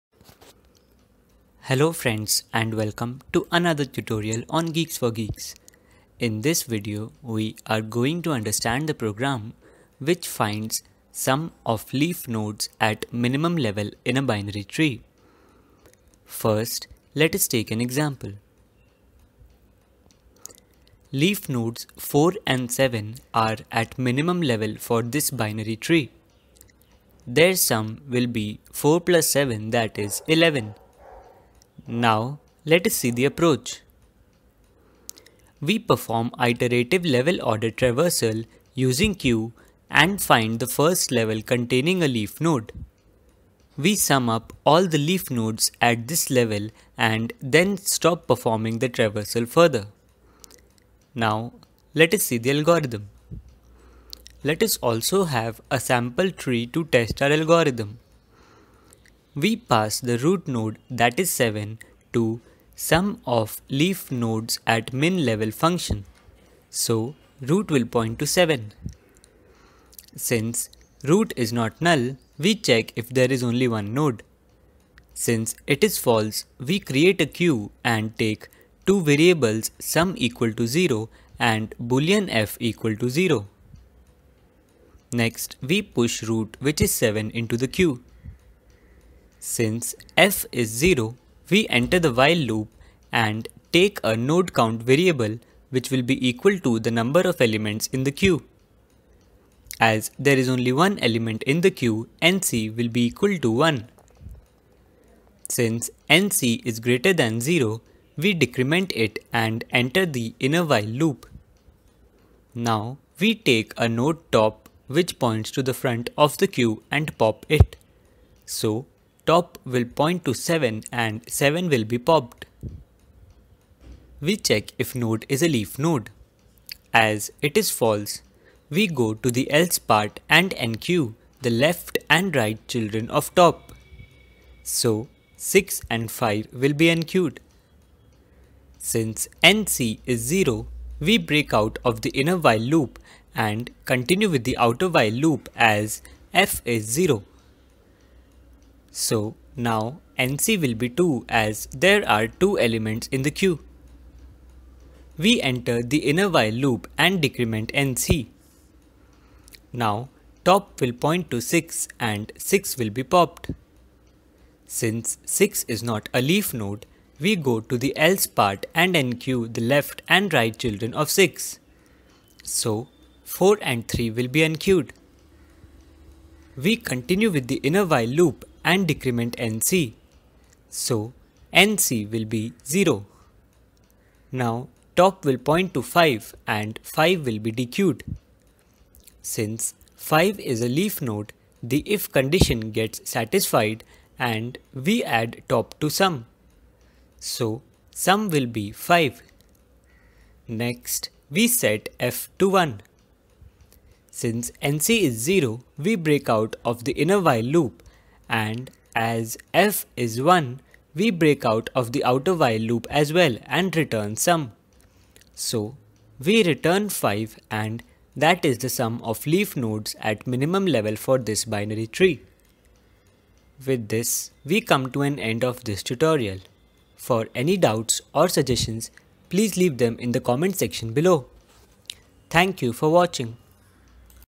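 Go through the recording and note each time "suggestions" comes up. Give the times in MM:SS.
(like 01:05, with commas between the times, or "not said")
03:48.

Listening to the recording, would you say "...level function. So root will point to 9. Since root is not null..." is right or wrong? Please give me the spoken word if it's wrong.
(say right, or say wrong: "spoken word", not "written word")
wrong: "7", not "9".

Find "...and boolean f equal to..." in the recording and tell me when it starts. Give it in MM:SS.
01:21.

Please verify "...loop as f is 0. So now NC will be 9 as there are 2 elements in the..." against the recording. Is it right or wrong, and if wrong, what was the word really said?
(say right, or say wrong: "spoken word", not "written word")
wrong: "2", not "9".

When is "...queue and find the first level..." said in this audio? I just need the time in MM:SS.
00:39.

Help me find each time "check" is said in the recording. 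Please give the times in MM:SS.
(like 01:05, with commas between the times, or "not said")
01:12, 02:04.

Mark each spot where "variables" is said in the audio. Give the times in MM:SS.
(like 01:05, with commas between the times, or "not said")
01:19, 01:34.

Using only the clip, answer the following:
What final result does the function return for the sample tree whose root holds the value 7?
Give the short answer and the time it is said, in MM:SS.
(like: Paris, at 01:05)
5, at 03:36.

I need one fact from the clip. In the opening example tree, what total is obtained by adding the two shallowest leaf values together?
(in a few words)
11.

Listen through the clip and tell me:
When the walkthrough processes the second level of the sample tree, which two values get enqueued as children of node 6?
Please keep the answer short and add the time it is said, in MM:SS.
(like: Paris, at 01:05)
4 and 3, at 02:53.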